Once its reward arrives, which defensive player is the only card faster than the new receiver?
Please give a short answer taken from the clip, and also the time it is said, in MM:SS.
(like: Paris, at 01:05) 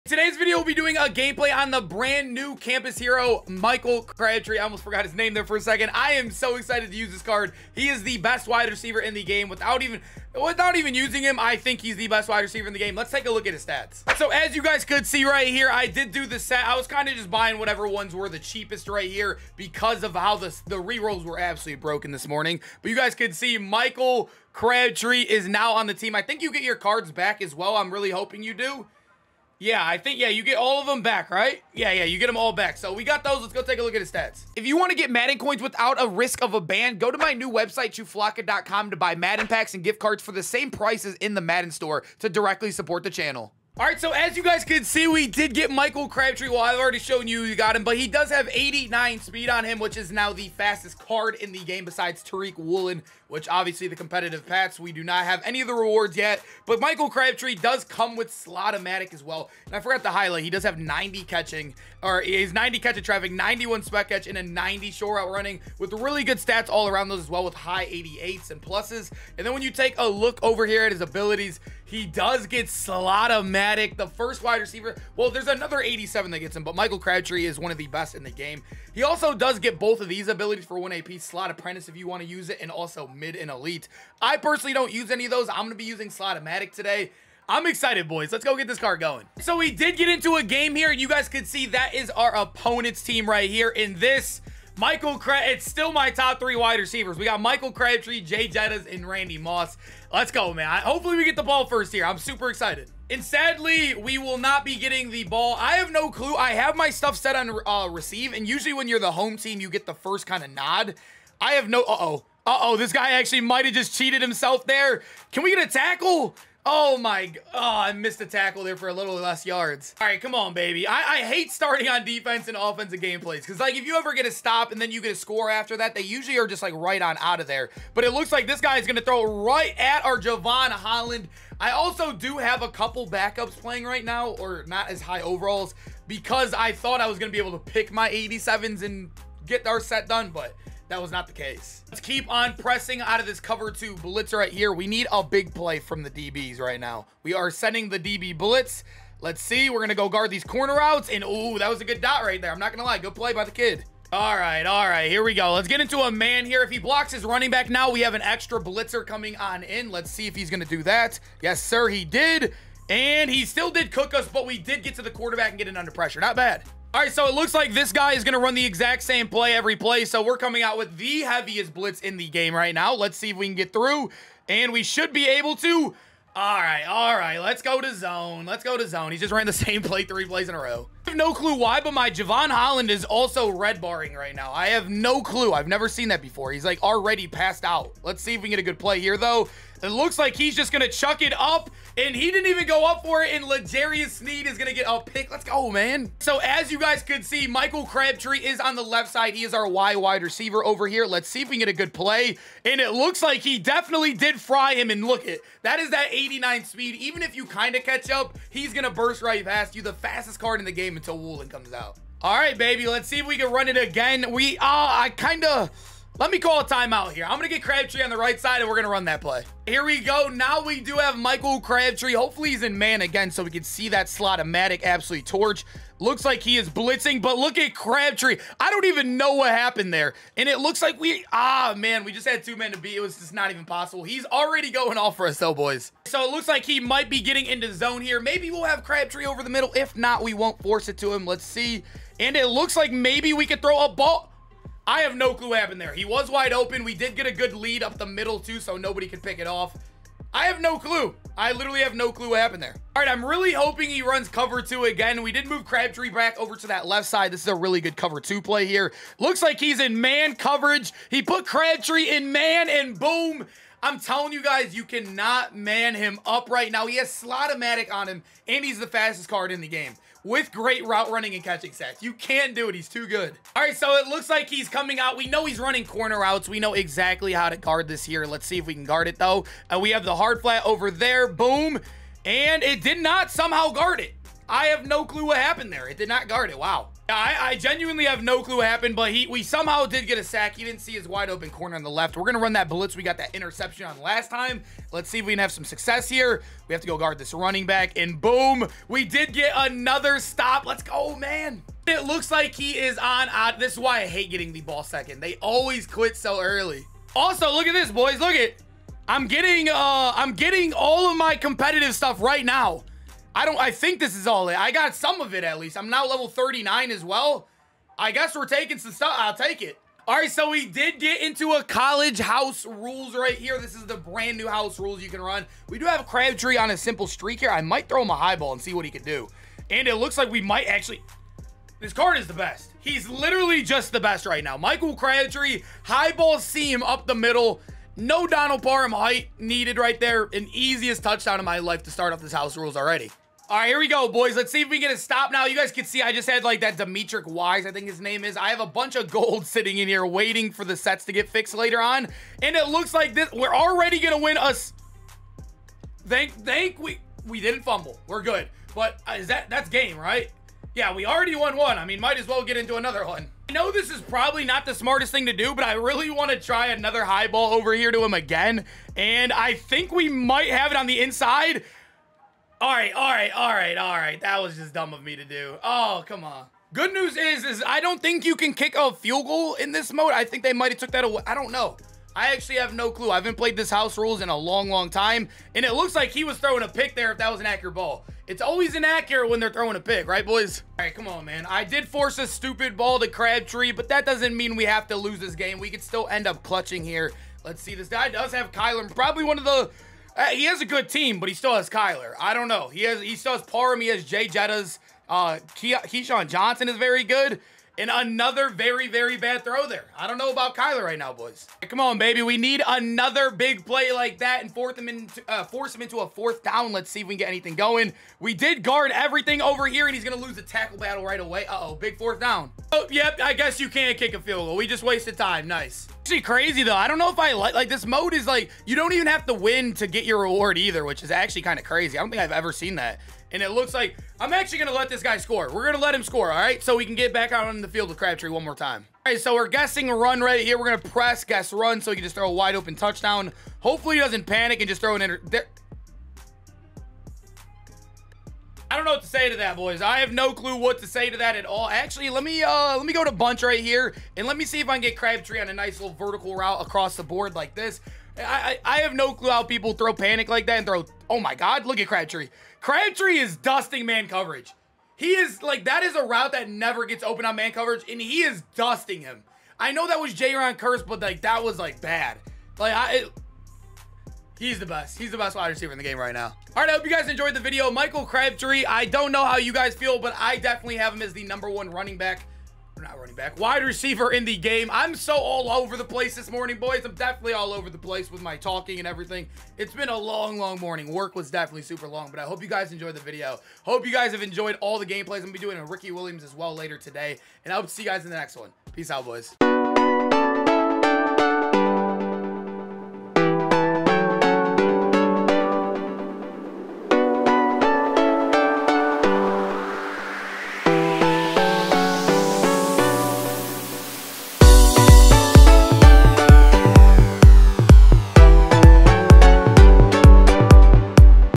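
Tariq Woolen, at 00:52.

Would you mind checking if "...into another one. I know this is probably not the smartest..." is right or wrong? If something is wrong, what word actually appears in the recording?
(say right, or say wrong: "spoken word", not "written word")
right.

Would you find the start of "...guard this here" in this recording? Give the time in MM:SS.
04:37.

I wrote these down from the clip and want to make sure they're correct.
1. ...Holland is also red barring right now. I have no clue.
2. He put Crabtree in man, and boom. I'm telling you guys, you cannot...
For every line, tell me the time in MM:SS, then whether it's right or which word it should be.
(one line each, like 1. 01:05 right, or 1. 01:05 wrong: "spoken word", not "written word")
1. 03:02 right
2. 04:21 right.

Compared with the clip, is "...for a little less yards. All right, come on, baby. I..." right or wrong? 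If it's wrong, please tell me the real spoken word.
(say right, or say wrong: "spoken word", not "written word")
right.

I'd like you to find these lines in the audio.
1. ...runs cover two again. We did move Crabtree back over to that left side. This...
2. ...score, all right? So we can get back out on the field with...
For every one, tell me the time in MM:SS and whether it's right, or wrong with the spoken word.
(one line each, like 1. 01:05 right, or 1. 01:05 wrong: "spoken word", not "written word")
1. 04:14 right
2. 07:16 right.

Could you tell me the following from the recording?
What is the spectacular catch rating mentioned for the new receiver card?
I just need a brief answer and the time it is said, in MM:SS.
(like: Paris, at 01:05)
91, at 01:03.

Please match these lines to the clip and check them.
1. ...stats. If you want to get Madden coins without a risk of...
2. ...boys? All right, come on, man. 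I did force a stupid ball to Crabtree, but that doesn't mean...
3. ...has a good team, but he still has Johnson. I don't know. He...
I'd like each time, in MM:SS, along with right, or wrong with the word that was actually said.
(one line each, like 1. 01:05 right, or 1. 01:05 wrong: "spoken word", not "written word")
1. 00:34 right
2. 06:30 right
3. 06:40 wrong: "Kyler", not "Johnson".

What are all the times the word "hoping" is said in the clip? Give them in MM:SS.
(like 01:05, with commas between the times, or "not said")
00:28, 04:13.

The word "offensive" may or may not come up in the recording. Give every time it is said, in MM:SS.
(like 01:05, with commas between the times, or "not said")
02:02.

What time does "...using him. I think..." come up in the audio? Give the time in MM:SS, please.
00:10.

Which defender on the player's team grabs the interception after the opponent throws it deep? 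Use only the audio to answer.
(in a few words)
L'Jarius Sneed.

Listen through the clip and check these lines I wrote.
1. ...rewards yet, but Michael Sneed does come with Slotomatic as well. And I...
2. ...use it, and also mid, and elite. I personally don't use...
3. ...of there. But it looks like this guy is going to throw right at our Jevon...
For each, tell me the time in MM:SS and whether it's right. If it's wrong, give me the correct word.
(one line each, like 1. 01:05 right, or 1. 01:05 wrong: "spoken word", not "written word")
1. 00:55 wrong: "Crabtree", not "Sneed"
2. 01:22 right
3. 02:07 right.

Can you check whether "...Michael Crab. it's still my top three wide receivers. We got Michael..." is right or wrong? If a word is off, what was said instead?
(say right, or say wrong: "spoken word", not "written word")
right.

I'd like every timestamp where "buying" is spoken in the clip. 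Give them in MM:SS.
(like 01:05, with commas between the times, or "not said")
00:17.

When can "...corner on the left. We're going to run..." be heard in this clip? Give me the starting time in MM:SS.
04:51.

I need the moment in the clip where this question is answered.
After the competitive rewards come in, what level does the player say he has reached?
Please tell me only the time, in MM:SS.
05:16.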